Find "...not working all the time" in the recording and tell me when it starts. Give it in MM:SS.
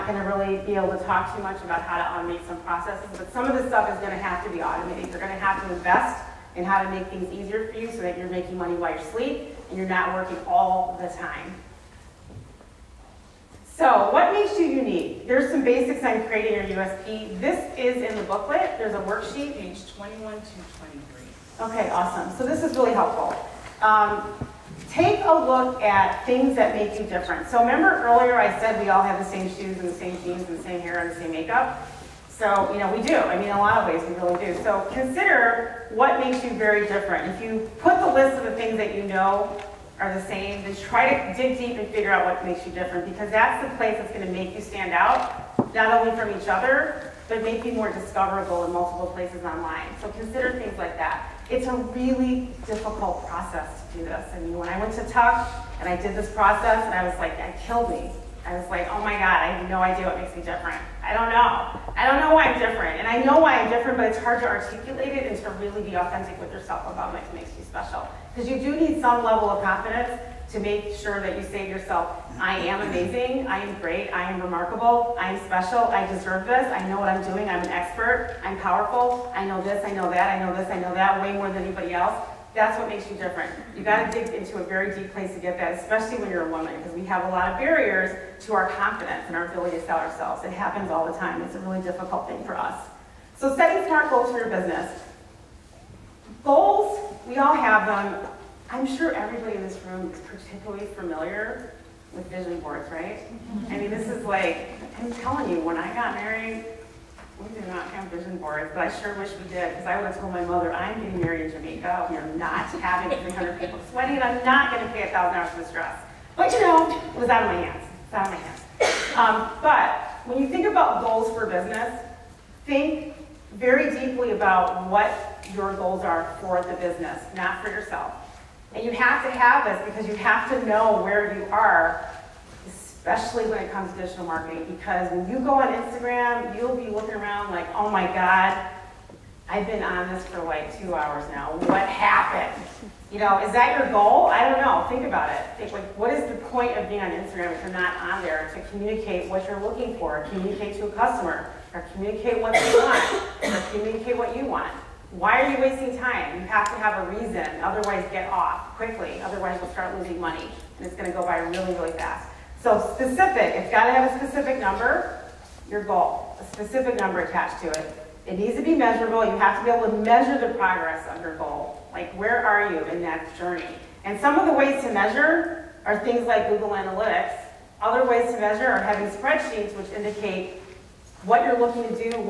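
00:09.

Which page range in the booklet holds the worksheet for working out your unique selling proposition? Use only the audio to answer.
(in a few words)
21 to 23.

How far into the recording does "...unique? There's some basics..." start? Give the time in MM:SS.
00:14.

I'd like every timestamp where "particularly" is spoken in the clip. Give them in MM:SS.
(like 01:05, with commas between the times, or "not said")
01:40.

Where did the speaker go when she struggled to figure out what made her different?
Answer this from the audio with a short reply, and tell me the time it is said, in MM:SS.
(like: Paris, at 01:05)
Tuck, at 00:55.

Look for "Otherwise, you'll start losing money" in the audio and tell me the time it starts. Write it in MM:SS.
02:39.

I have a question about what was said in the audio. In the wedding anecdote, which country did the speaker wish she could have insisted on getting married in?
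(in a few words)
Jamaica.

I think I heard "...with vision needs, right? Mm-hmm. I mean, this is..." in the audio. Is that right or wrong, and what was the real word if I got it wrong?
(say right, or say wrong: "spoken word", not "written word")
wrong: "boards", not "needs".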